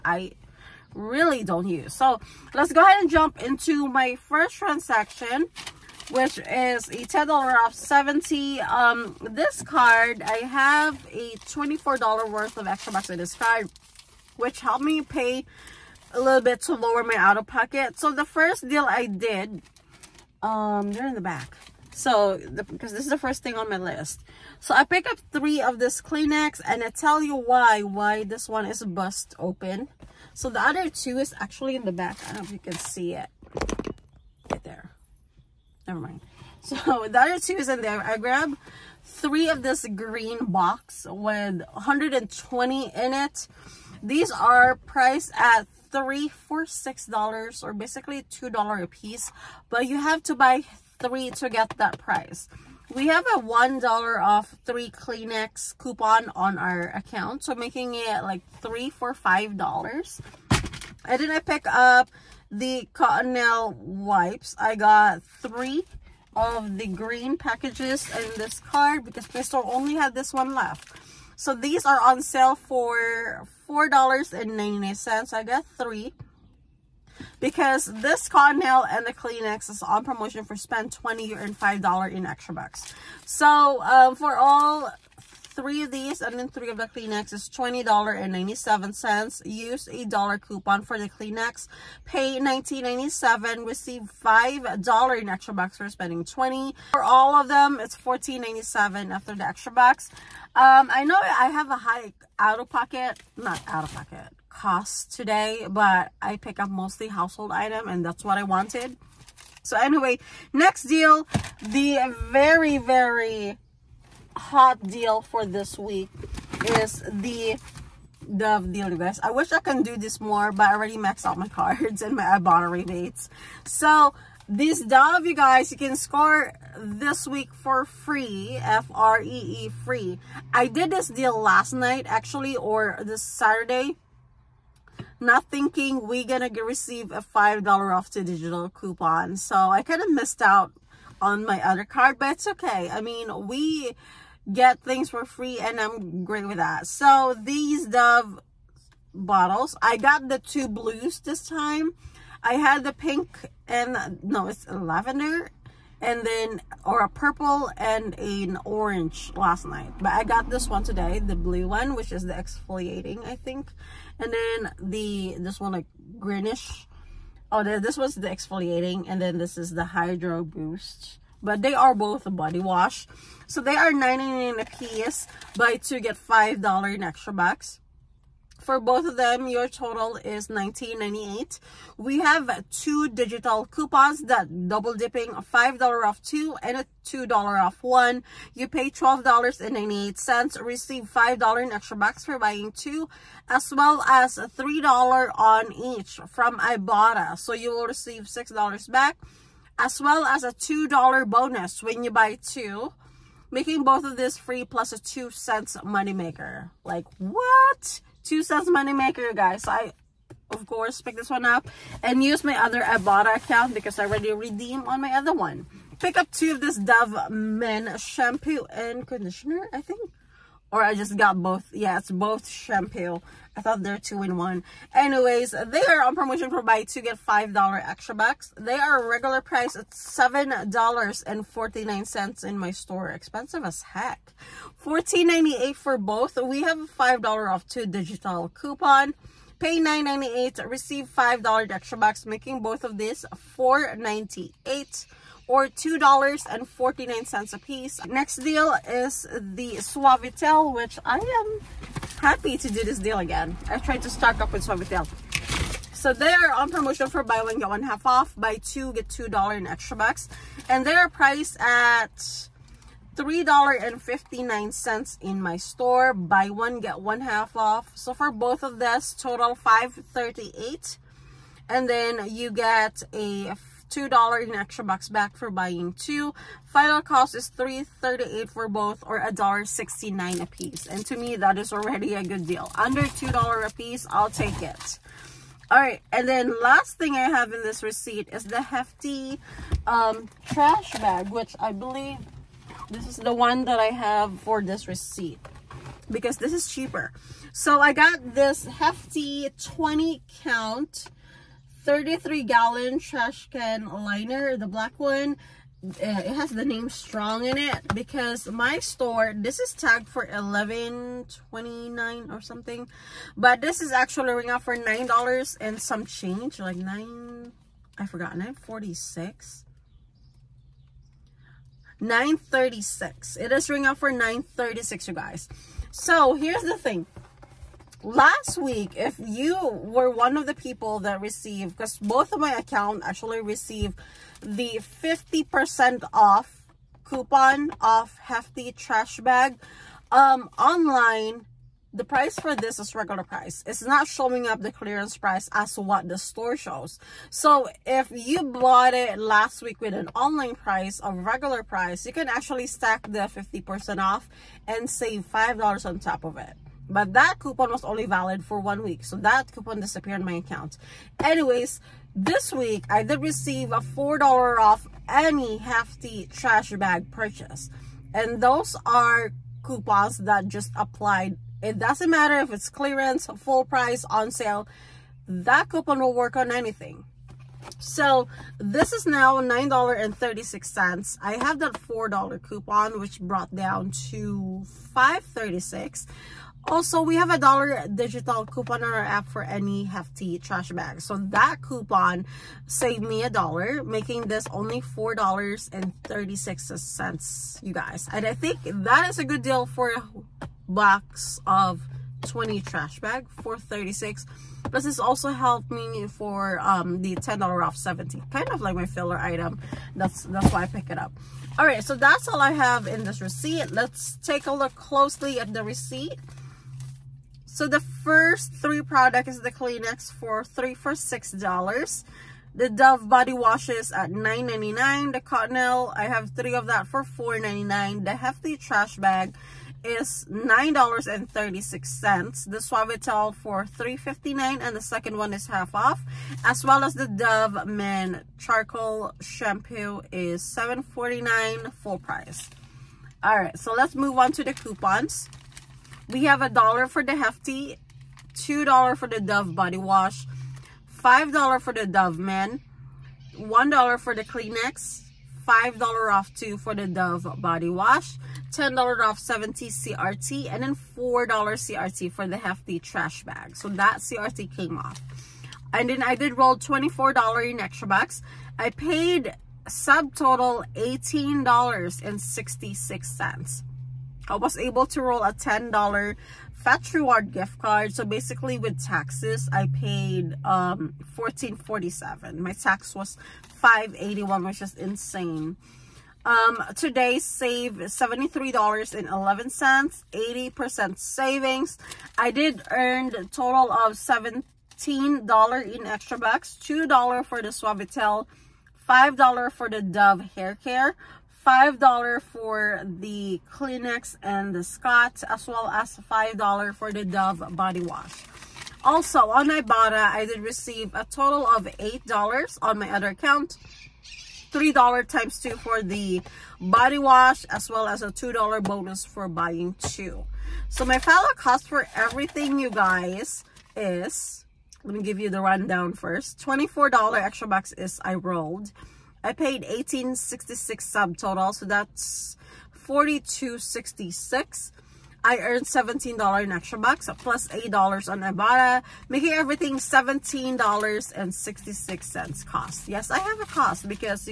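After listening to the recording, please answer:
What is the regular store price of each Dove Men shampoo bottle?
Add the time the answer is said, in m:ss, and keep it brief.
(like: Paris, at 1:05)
$7.49, at 3:49.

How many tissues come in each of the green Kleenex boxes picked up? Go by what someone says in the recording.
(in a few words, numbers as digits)
120.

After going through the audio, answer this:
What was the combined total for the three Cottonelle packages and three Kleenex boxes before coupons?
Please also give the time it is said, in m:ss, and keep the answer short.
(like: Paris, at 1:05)
$20.97, at 1:27.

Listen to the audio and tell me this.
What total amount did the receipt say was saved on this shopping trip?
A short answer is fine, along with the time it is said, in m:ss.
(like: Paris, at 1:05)
$73.11, at 8:07.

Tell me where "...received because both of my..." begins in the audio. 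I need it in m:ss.
5:31.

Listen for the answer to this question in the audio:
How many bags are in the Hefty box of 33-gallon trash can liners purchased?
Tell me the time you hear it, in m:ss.
4:59.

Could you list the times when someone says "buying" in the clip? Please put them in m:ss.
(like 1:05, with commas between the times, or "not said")
3:12, 4:35, 8:39.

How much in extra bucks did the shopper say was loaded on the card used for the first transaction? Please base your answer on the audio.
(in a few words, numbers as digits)
$24.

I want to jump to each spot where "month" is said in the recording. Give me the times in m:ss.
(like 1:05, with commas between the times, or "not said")
not said.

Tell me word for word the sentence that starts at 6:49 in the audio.
That's, that's why I pick it up.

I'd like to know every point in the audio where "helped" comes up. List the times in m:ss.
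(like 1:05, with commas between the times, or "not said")
0:14, 6:45.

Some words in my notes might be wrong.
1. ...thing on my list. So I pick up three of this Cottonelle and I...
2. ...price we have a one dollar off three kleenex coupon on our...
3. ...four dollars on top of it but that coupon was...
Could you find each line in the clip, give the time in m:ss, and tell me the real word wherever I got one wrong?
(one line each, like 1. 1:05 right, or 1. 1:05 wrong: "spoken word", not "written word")
1. 0:23 wrong: "Kleenex", not "Cottonelle"
2. 0:51 right
3. 5:55 wrong: "five", not "four".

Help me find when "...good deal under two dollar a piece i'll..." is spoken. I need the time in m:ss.
4:42.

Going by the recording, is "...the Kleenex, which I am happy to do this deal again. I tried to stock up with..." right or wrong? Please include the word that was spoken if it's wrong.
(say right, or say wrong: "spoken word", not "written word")
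wrong: "Suavitel", not "Kleenex".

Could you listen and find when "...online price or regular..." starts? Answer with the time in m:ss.
5:50.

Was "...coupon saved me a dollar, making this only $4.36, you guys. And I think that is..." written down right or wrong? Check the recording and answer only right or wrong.
right.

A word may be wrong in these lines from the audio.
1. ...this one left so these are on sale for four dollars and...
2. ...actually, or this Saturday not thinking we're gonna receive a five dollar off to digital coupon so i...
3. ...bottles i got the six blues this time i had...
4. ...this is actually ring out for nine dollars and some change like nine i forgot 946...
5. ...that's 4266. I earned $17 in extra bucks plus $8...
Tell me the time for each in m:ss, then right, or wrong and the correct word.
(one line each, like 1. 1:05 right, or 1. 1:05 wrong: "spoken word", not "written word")
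1. 1:10 right
2. 2:12 right
3. 2:29 wrong: "two", not "six"
4. 5:13 right
5. 8:51 right.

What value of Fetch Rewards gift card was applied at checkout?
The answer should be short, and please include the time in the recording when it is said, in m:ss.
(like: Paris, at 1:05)
$10, at 7:55.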